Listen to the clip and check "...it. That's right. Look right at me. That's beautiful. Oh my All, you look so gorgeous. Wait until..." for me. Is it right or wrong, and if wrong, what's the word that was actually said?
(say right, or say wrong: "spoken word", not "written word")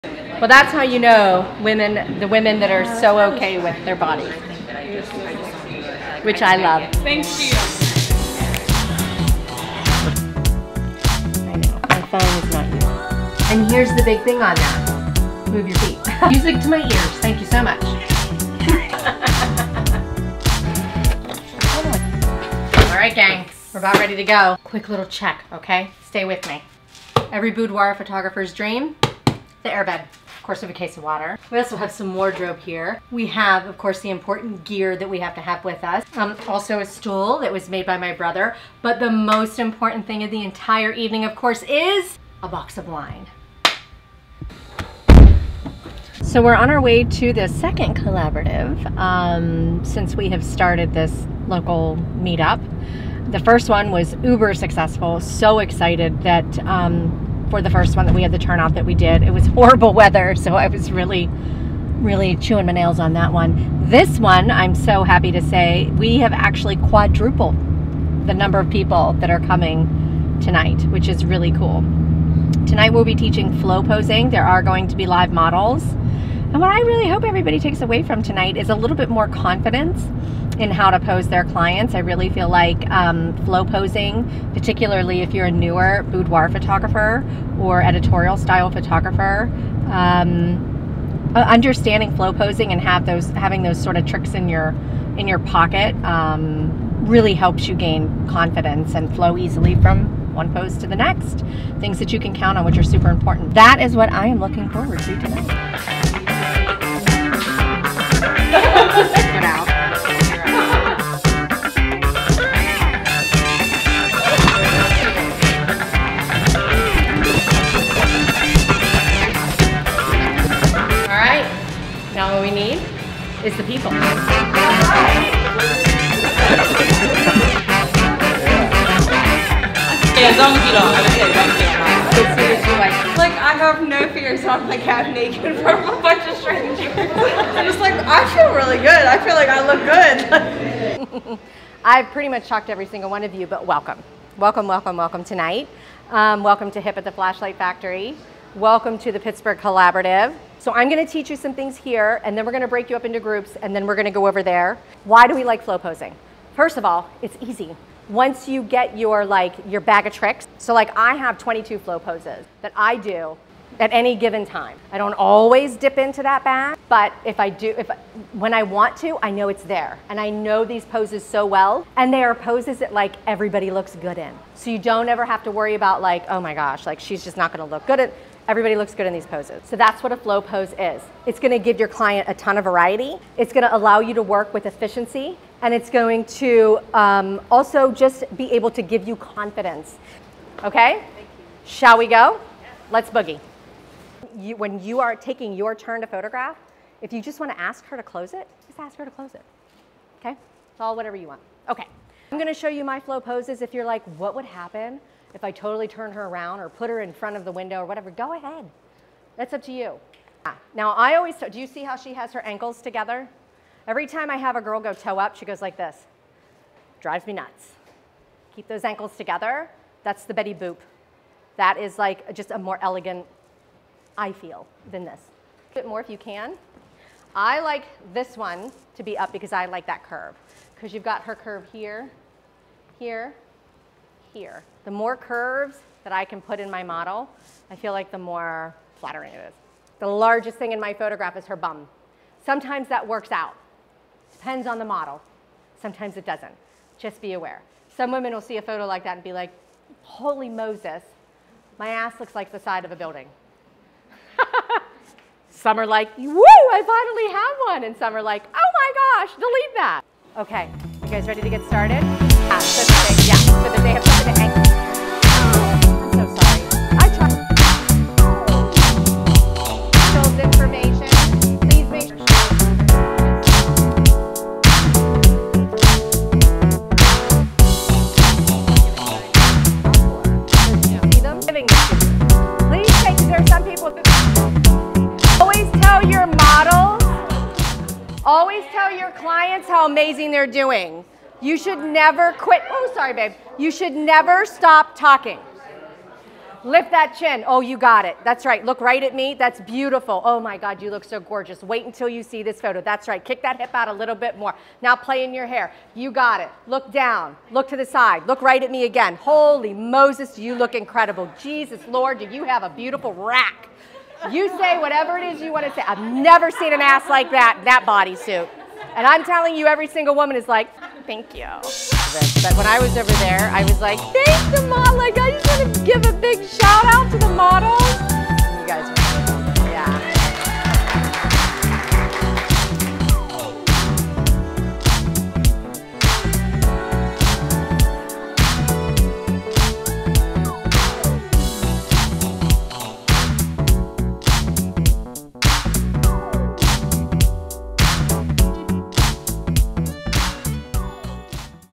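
wrong: "God", not "All".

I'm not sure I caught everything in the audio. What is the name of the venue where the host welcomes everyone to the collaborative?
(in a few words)
Flashlight Factory.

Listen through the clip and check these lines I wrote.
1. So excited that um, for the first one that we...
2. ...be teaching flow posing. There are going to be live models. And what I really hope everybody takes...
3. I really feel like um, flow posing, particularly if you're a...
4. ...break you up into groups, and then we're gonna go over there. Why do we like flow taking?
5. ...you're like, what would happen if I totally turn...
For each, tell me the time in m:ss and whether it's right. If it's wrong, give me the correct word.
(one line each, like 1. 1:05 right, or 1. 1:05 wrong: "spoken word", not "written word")
1. 0:55 right
2. 1:13 right
3. 1:21 right
4. 2:32 wrong: "posing", not "taking"
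5. 3:23 right.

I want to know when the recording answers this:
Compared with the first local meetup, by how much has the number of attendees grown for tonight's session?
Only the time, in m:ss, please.
1:06.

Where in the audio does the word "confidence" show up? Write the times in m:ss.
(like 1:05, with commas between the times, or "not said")
1:19, 1:38, 3:09.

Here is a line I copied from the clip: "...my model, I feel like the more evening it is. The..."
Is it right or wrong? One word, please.
wrong.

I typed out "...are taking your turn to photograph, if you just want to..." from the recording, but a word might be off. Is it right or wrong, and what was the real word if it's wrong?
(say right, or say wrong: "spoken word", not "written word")
right.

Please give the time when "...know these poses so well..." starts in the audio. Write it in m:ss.
2:50.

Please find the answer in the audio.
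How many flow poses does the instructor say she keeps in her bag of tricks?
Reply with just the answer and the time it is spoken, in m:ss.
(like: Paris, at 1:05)
22, at 2:41.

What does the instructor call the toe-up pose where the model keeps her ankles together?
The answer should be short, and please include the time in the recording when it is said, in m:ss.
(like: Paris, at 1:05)
The Betty Boop, at 3:40.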